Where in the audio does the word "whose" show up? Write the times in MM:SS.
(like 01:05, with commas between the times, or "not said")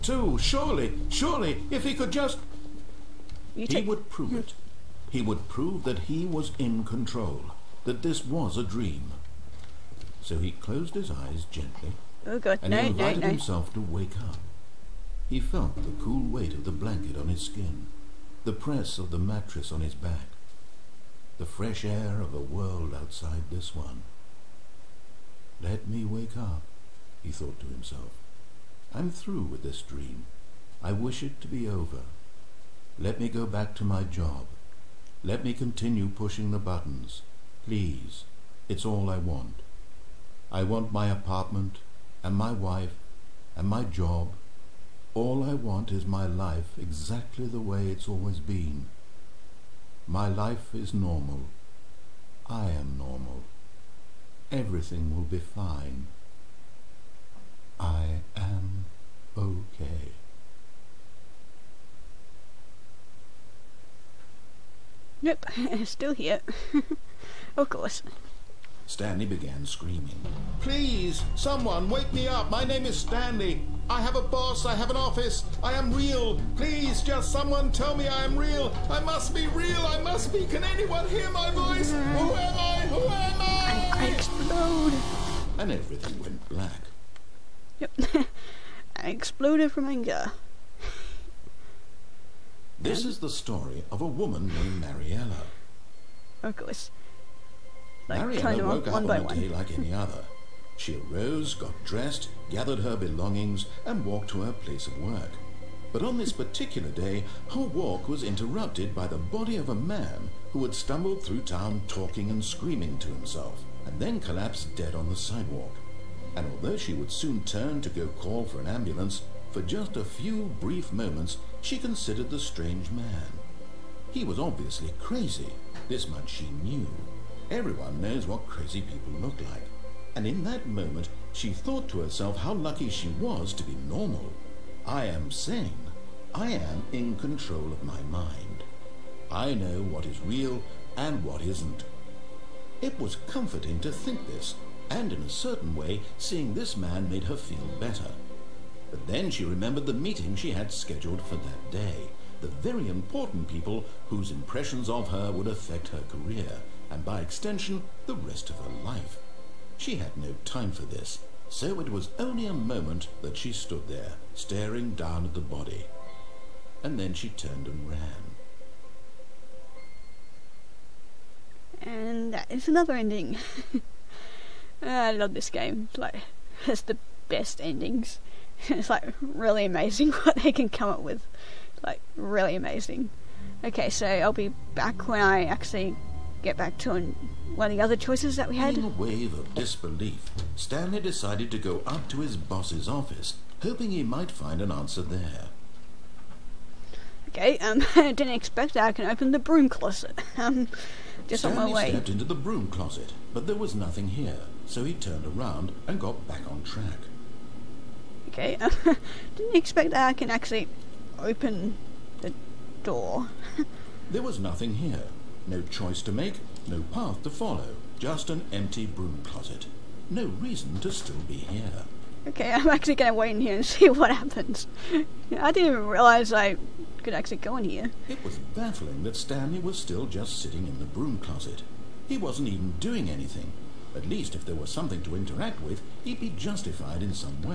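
02:34.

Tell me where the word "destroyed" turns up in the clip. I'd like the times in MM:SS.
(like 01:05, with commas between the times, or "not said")
not said.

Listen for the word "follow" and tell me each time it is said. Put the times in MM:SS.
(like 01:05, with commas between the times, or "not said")
03:37.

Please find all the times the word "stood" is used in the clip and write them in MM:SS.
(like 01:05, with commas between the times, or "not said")
02:43.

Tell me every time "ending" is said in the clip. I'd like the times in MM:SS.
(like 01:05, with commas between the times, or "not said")
02:52, 02:57.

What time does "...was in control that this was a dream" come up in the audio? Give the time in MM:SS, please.
00:06.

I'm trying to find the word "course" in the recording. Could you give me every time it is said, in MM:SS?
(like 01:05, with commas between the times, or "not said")
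01:07, 01:36.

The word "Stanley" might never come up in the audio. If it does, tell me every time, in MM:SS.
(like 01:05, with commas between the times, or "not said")
01:08, 01:12, 03:10, 03:21, 03:49.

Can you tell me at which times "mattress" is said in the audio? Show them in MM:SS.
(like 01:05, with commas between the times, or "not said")
00:19.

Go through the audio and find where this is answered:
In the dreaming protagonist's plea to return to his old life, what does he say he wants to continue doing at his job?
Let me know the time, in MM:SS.
00:36.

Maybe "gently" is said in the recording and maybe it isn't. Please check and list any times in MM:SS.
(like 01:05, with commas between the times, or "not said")
00:11.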